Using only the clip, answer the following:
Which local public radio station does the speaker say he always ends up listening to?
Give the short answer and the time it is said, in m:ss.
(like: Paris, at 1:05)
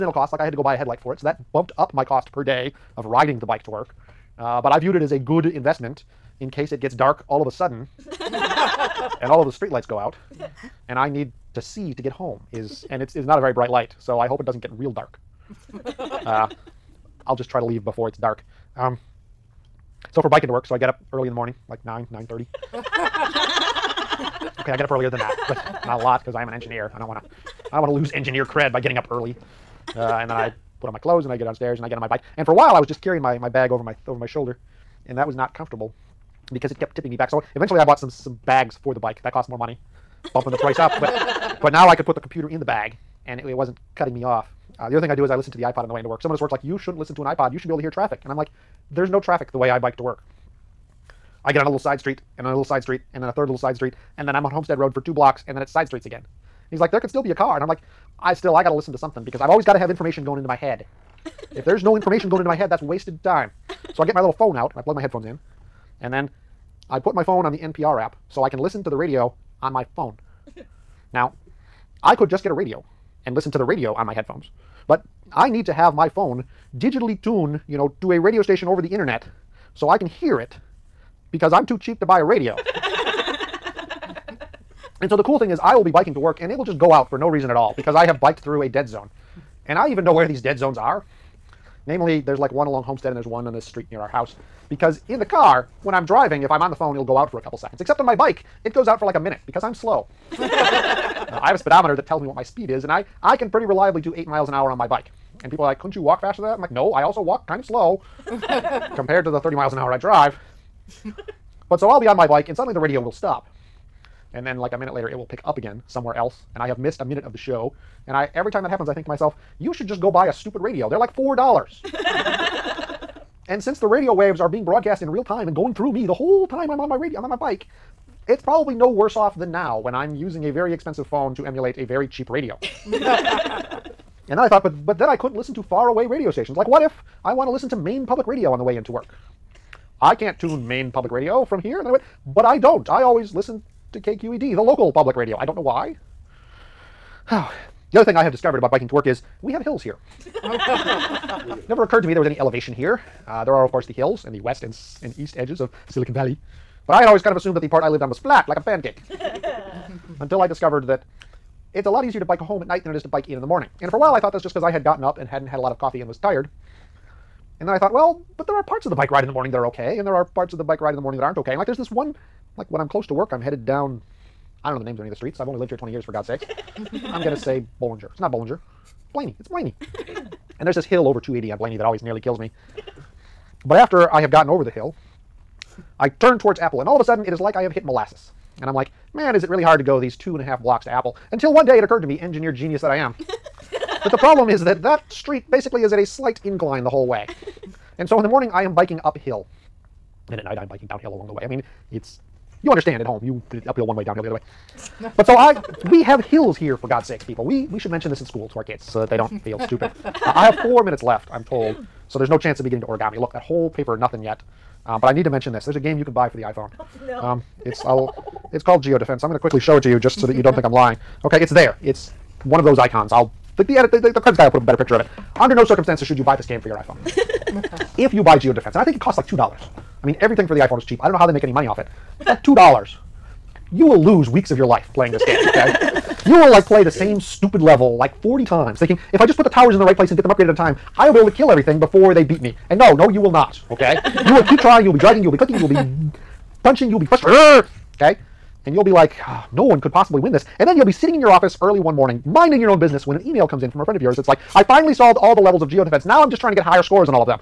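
KQED, at 2:23.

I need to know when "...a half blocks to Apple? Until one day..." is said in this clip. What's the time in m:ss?
3:10.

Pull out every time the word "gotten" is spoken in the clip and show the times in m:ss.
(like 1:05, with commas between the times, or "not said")
2:44, 3:04.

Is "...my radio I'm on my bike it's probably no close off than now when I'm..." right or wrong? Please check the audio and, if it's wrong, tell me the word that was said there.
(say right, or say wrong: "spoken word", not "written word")
wrong: "worse", not "close".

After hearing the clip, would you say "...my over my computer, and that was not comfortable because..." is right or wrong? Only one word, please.
wrong.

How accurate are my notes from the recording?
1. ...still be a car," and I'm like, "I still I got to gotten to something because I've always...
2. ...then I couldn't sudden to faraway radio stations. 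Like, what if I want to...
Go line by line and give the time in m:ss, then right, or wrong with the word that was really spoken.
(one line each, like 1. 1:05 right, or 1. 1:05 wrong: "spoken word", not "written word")
1. 0:57 wrong: "listen", not "gotten"
2. 2:14 wrong: "listen", not "sudden".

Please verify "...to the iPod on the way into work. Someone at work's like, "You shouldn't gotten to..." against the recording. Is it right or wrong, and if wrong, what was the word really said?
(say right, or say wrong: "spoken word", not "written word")
wrong: "listen", not "gotten".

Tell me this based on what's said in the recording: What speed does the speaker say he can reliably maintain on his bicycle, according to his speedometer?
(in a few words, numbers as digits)
8 miles an hour.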